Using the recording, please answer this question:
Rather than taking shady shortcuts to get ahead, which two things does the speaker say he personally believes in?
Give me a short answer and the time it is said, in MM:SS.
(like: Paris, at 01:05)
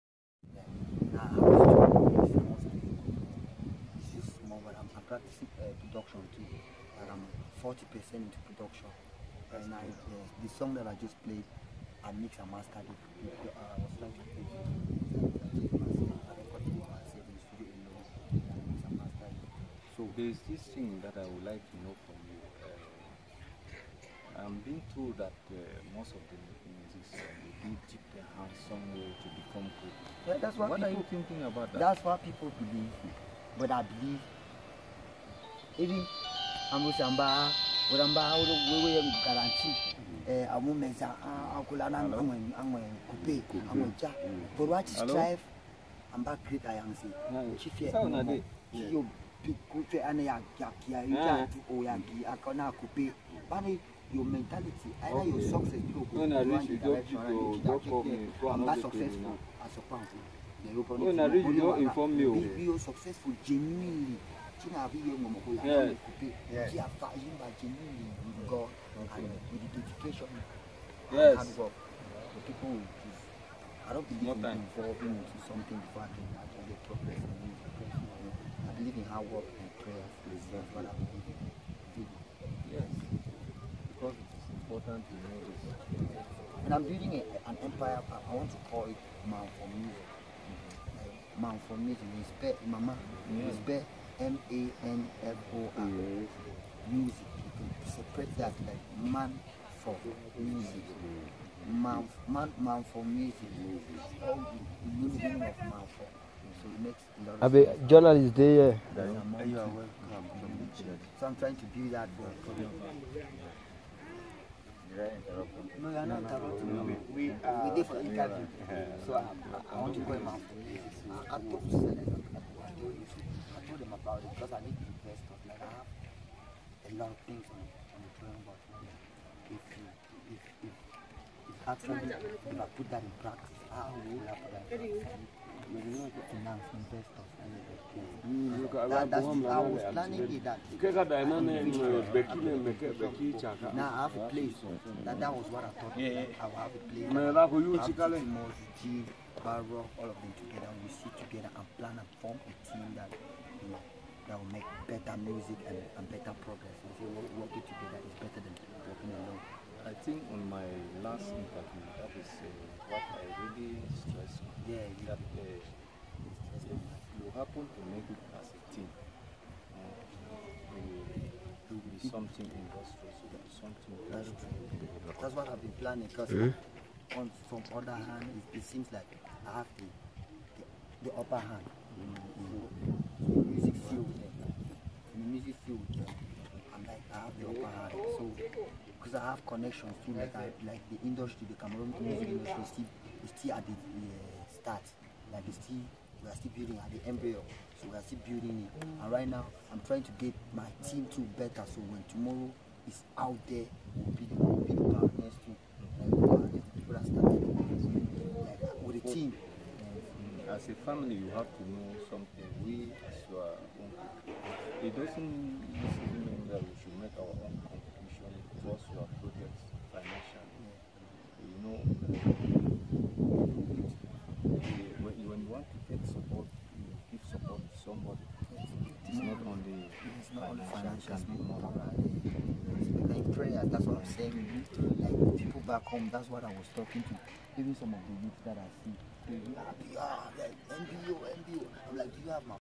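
hard work and prayer, at 01:19.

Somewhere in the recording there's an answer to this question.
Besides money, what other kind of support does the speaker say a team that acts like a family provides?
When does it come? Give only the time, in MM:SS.
03:51.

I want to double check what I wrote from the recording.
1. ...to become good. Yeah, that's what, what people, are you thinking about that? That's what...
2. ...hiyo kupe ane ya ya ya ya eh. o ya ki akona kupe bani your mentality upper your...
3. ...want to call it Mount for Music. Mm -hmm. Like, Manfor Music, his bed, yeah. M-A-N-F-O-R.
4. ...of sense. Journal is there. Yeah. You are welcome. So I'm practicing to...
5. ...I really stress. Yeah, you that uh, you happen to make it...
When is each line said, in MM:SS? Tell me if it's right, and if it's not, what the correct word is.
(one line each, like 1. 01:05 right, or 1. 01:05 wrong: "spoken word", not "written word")
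1. 00:29 right
2. 00:48 wrong: "either", not "upper"
3. 01:28 right
4. 01:47 wrong: "trying", not "practicing"
5. 02:43 right.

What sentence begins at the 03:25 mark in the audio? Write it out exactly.
the people that with the team as a family, you have to know something.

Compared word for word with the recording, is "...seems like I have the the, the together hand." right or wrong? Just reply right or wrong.
wrong.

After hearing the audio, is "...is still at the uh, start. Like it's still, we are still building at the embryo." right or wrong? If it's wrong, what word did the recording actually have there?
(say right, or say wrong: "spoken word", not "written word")
right.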